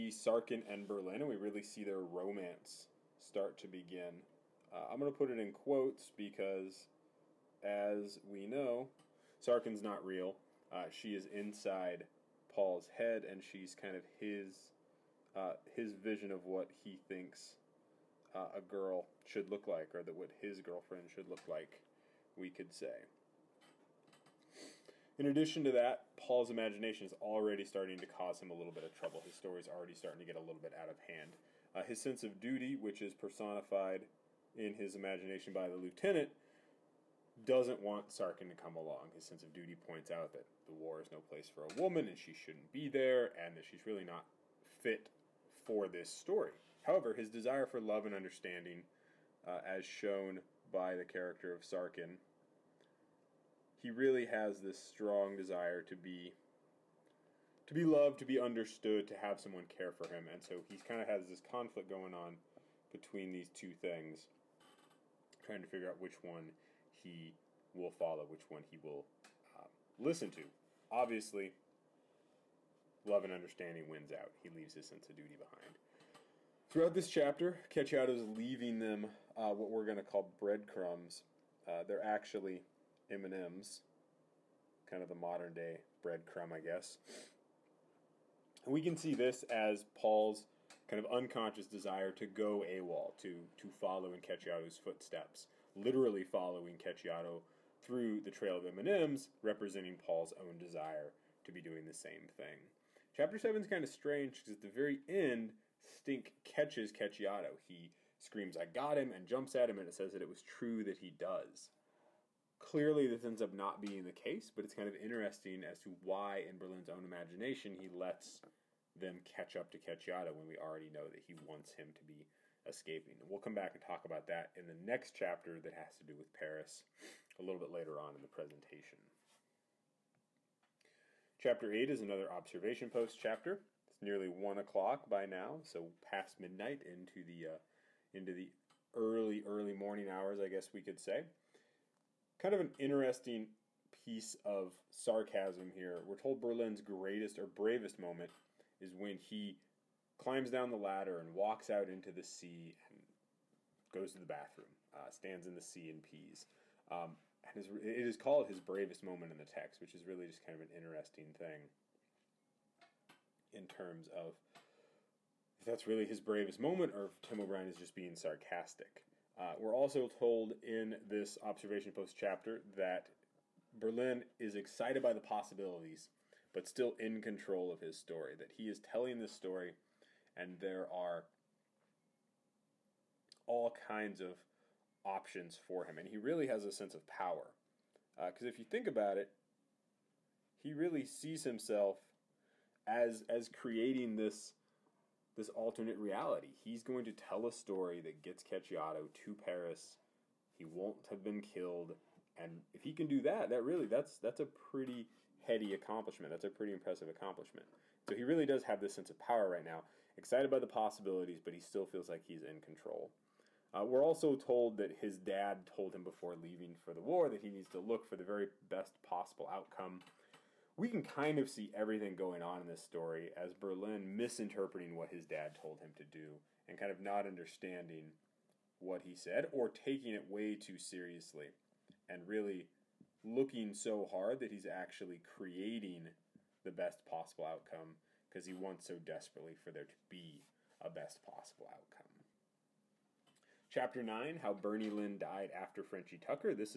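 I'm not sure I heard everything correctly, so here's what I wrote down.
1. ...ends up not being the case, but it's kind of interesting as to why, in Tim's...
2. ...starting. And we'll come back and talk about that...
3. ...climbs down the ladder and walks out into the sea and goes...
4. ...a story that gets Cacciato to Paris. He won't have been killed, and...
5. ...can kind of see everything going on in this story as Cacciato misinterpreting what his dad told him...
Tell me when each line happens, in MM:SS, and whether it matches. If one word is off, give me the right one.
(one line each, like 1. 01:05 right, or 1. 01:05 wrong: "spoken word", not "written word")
1. 01:53 wrong: "Berlin", not "Tim"
2. 02:02 wrong: "escaping", not "starting"
3. 02:30 right
4. 03:17 right
5. 03:40 wrong: "Berlin", not "Cacciato".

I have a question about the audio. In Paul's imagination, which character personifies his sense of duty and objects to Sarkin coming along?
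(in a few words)
The lieutenant.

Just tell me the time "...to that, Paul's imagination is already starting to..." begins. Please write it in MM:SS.
00:25.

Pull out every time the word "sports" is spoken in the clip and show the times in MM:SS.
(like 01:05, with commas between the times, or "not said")
not said.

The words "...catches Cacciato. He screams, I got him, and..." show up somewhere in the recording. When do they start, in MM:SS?
01:46.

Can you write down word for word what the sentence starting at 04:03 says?
Chapter 9 How Bernie Lynn Died After Frenchie Tucker.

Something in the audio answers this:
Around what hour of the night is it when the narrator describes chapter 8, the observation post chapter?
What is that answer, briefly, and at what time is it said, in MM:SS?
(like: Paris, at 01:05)
1 o'clock, at 02:14.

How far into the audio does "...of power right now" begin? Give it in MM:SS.
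03:29.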